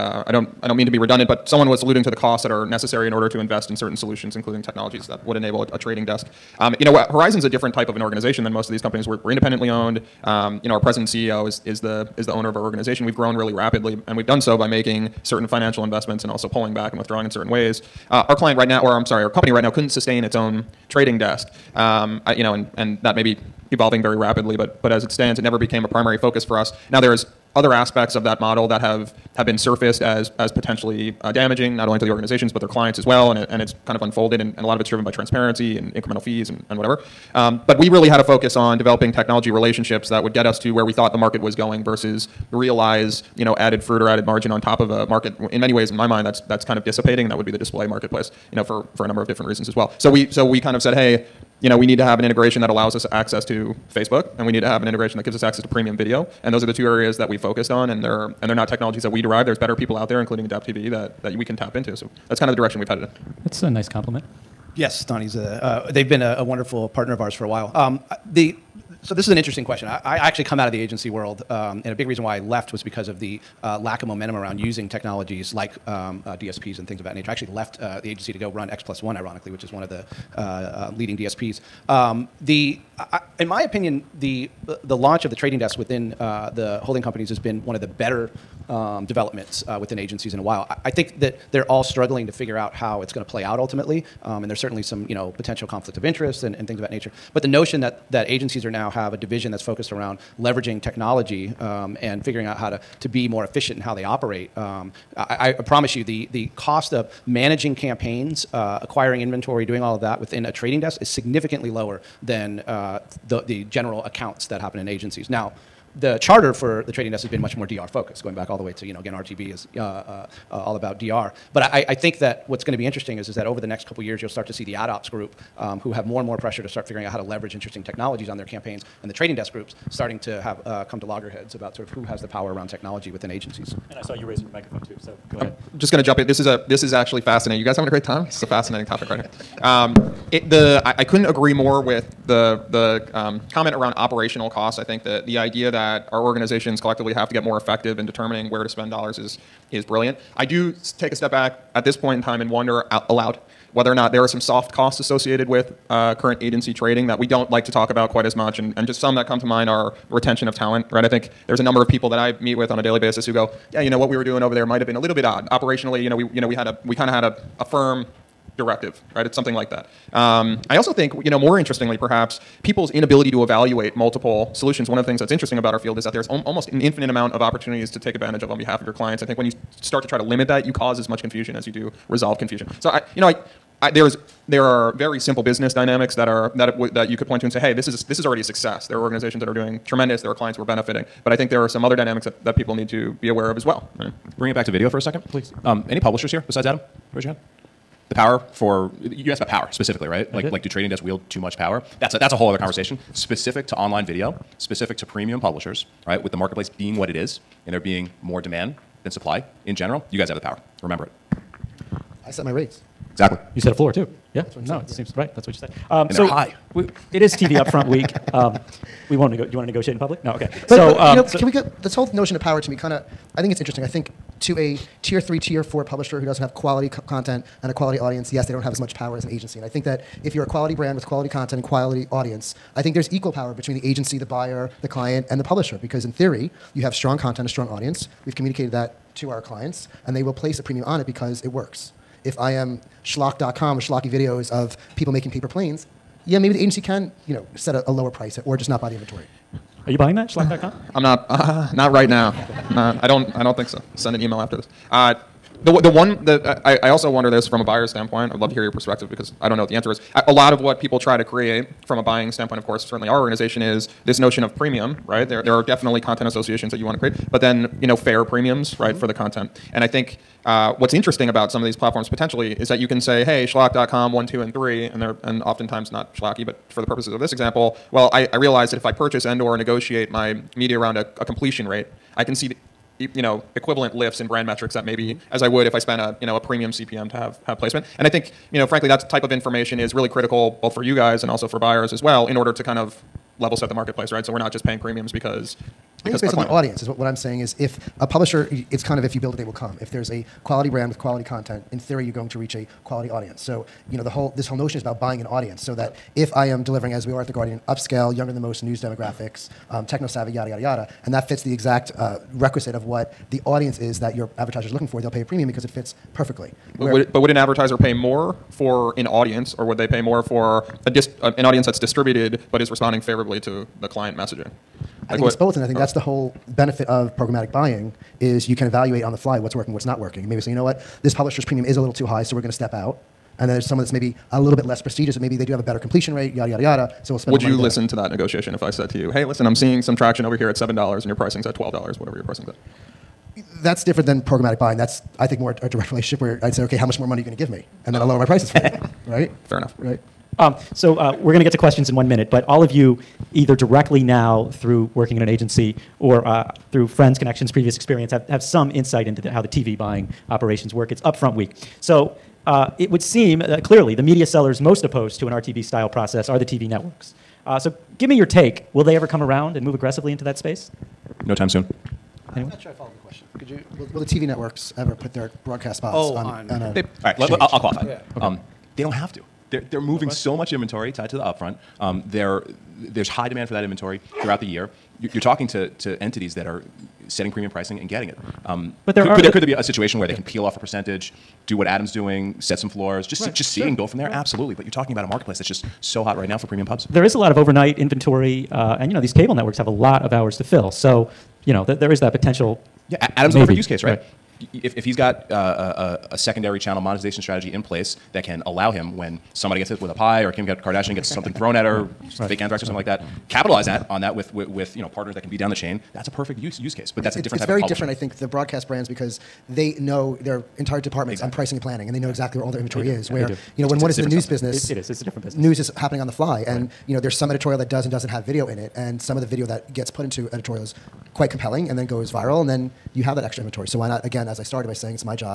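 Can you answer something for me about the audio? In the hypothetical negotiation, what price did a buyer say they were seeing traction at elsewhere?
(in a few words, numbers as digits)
$7.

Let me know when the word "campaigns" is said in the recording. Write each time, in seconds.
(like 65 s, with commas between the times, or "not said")
107 s, 128 s.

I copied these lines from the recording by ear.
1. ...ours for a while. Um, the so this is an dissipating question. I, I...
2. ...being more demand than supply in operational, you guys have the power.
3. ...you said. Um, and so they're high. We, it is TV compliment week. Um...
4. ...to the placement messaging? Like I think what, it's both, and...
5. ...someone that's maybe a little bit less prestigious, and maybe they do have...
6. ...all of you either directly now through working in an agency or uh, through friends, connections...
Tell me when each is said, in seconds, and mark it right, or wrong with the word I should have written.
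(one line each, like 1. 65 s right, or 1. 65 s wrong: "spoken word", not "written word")
1. 67 s wrong: "interesting", not "dissipating"
2. 207 s wrong: "general", not "operational"
3. 215 s wrong: "upfront", not "compliment"
4. 323 s wrong: "client", not "placement"
5. 333 s right
6. 352 s right.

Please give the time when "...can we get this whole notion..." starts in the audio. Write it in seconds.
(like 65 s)
221 s.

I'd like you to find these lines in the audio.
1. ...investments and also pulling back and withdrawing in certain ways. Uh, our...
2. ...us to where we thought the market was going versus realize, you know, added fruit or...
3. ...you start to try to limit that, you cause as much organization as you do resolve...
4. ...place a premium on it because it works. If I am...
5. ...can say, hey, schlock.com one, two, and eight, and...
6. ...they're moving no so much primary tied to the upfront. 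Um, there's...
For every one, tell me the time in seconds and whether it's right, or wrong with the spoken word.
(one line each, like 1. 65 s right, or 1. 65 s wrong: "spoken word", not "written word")
1. 15 s right
2. 40 s right
3. 179 s wrong: "confusion", not "organization"
4. 240 s right
5. 272 s wrong: "three", not "eight"
6. 379 s wrong: "inventory", not "primary".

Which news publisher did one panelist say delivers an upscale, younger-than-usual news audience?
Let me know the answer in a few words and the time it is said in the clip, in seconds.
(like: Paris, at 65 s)
The Guardian, at 307 s.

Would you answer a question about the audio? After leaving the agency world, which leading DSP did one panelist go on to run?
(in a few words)
X plus one.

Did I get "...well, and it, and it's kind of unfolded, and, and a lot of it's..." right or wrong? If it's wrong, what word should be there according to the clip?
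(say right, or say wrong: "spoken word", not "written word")
right.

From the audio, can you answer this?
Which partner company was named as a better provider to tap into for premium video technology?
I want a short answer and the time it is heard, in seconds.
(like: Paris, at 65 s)
Adapt TV, at 60 s.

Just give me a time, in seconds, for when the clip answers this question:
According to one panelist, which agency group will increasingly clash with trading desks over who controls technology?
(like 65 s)
124 s.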